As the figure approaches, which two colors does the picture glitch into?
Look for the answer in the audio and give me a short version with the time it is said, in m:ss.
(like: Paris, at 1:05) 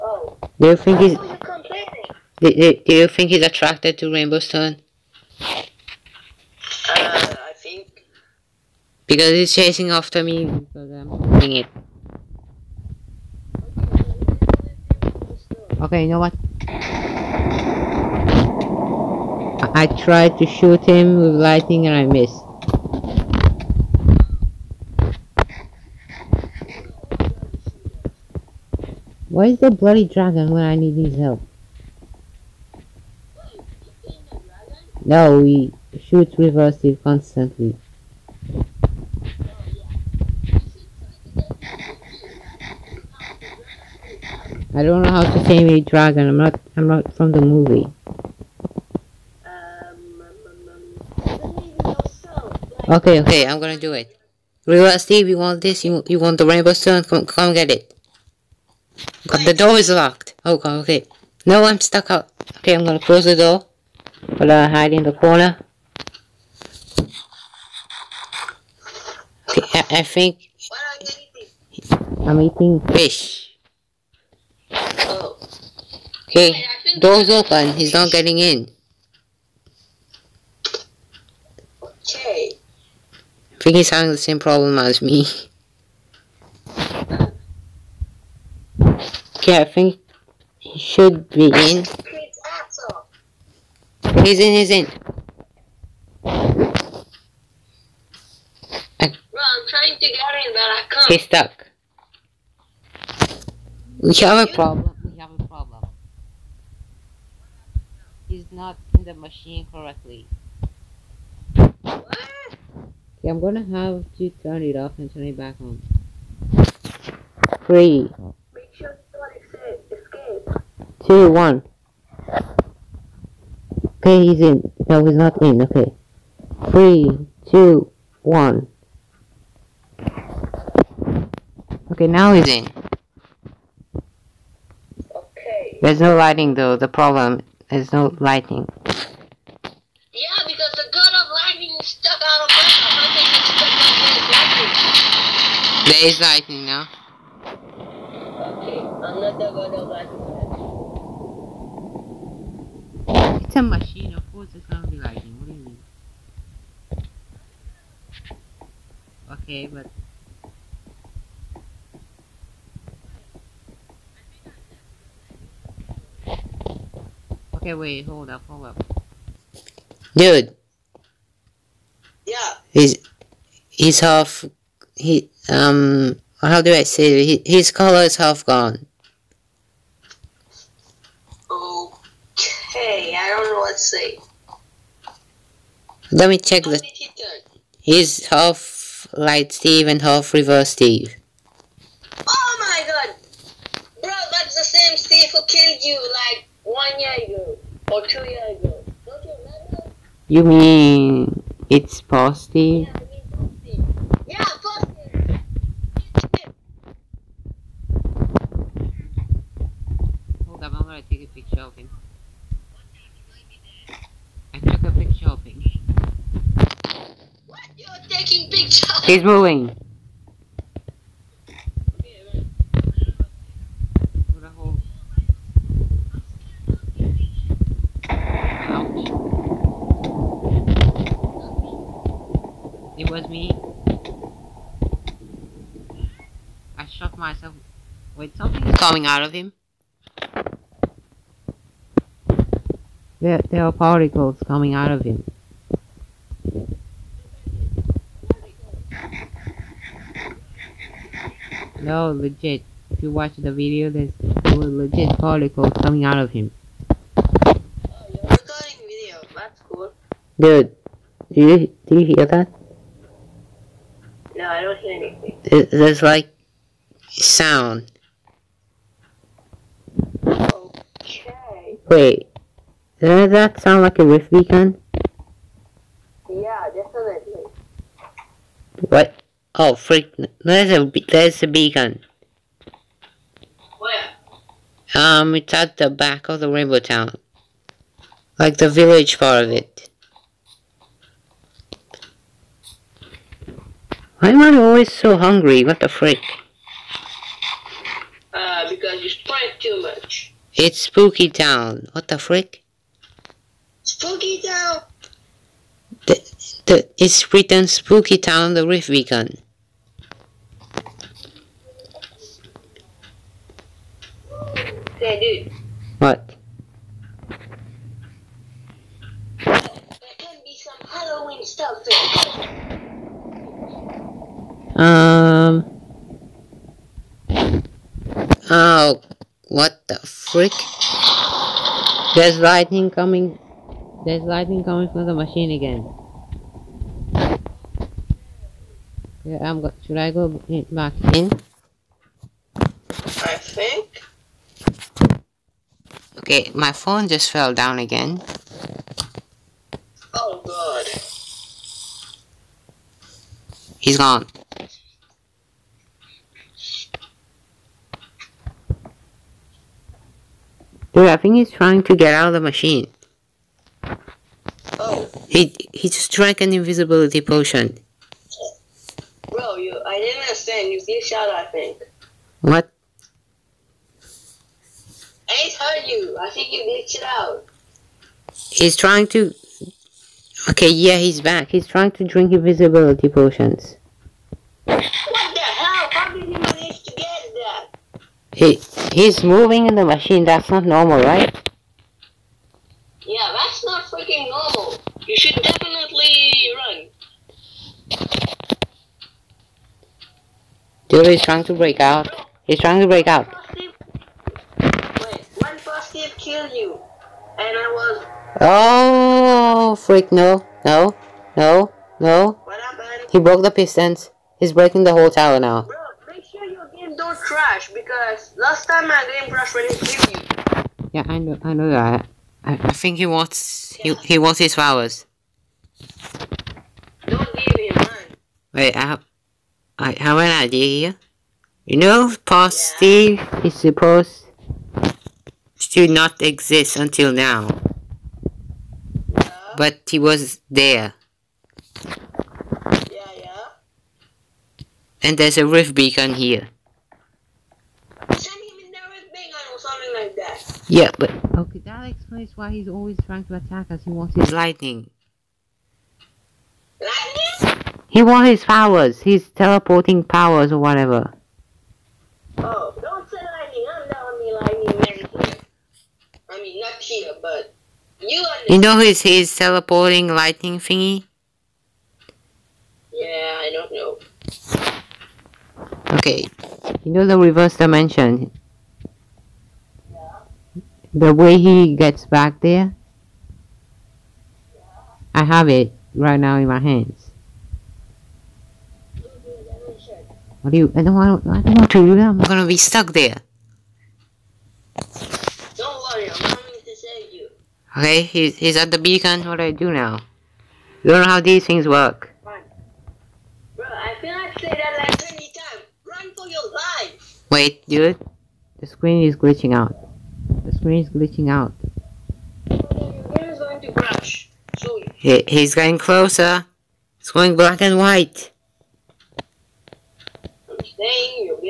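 Black and white, at 8:37.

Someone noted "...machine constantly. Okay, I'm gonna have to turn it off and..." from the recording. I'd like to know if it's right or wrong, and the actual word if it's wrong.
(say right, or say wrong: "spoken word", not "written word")
wrong: "correctly", not "constantly".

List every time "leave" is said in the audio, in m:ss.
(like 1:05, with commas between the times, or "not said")
7:07.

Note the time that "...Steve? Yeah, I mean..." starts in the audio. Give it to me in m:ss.
3:22.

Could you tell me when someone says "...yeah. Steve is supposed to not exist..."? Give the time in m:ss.
7:12.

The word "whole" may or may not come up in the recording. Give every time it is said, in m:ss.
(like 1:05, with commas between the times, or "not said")
6:54.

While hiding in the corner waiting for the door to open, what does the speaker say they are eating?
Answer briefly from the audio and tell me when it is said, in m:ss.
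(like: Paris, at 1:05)
Fish, at 1:12.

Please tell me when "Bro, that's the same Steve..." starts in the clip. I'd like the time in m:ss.
3:14.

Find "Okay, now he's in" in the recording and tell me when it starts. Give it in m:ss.
2:11.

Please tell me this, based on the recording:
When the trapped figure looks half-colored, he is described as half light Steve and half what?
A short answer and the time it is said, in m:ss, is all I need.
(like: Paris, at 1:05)
Reverse Steve, at 3:10.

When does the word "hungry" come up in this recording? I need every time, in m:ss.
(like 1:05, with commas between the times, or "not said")
4:55.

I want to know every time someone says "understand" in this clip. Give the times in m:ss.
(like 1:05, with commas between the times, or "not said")
6:10, 7:48.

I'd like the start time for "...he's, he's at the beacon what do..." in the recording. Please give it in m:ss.
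8:18.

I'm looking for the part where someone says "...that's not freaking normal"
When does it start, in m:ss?
6:33.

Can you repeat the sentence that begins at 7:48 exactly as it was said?
You know his his teleporting lightning thingy.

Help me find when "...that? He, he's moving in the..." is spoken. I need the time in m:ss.
6:27.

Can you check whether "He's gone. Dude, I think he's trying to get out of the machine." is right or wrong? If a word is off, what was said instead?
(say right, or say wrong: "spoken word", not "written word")
right.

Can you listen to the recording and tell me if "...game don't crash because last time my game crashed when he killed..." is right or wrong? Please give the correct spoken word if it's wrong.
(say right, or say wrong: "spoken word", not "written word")
right.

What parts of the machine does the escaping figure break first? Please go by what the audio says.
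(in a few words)
The pistons.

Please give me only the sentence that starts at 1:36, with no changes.
I, am trying to get in, but I can't.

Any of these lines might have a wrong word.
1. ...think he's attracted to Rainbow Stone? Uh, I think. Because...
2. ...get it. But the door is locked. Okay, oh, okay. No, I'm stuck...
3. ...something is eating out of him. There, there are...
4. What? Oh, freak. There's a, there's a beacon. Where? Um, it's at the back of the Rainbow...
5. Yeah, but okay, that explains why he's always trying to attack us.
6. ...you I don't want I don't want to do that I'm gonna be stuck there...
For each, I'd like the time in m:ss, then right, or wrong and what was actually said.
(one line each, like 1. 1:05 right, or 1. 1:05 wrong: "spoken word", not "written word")
1. 0:03 right
2. 0:57 right
3. 3:58 wrong: "coming", not "eating"
4. 4:38 right
5. 7:30 right
6. 8:10 right.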